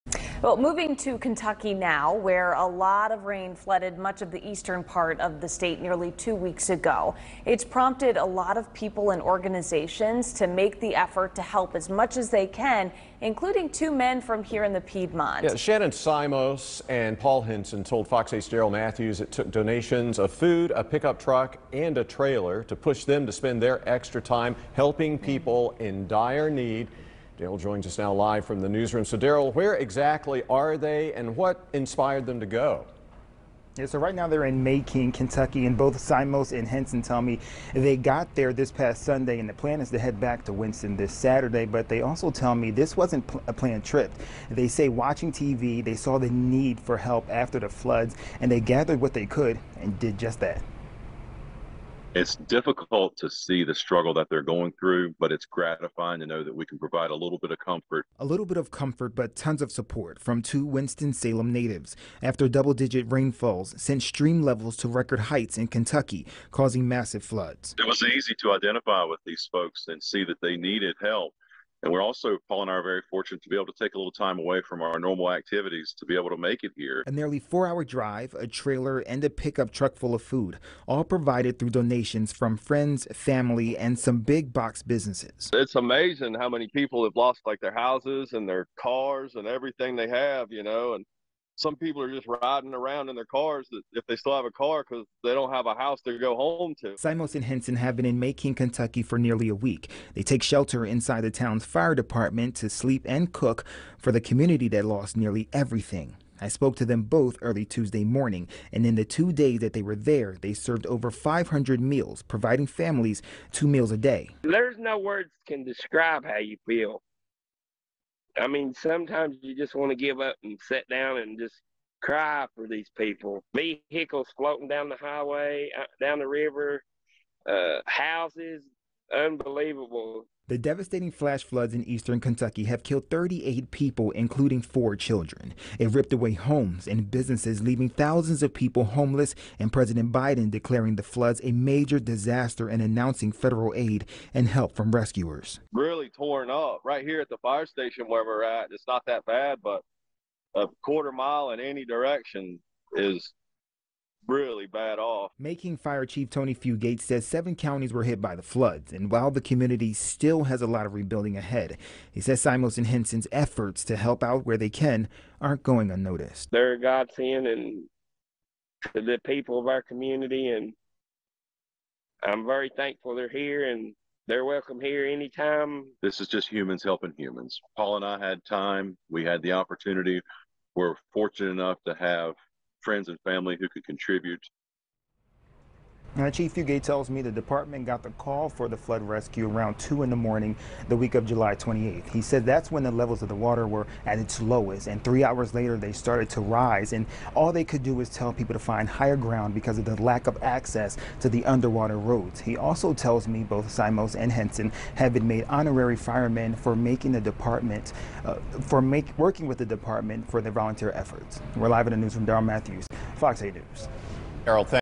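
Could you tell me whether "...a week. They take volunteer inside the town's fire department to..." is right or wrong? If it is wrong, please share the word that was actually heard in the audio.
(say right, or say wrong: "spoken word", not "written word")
wrong: "shelter", not "volunteer".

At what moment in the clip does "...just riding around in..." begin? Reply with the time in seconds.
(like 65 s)
92 s.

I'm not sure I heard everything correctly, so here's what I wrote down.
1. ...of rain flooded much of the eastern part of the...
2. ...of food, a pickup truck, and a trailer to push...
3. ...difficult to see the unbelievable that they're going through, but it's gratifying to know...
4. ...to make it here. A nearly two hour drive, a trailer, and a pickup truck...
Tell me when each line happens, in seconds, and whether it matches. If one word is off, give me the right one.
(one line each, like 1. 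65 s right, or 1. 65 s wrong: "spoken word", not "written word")
1. 3 s right
2. 20 s right
3. 52 s wrong: "struggle", not "unbelievable"
4. 76 s wrong: "four", not "two".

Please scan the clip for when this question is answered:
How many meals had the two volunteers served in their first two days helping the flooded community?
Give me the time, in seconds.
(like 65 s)
110 s.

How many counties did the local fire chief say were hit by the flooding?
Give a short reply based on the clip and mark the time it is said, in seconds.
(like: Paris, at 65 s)
7, at 157 s.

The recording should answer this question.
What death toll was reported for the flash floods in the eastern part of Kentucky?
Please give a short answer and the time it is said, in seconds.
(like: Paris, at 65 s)
38, at 133 s.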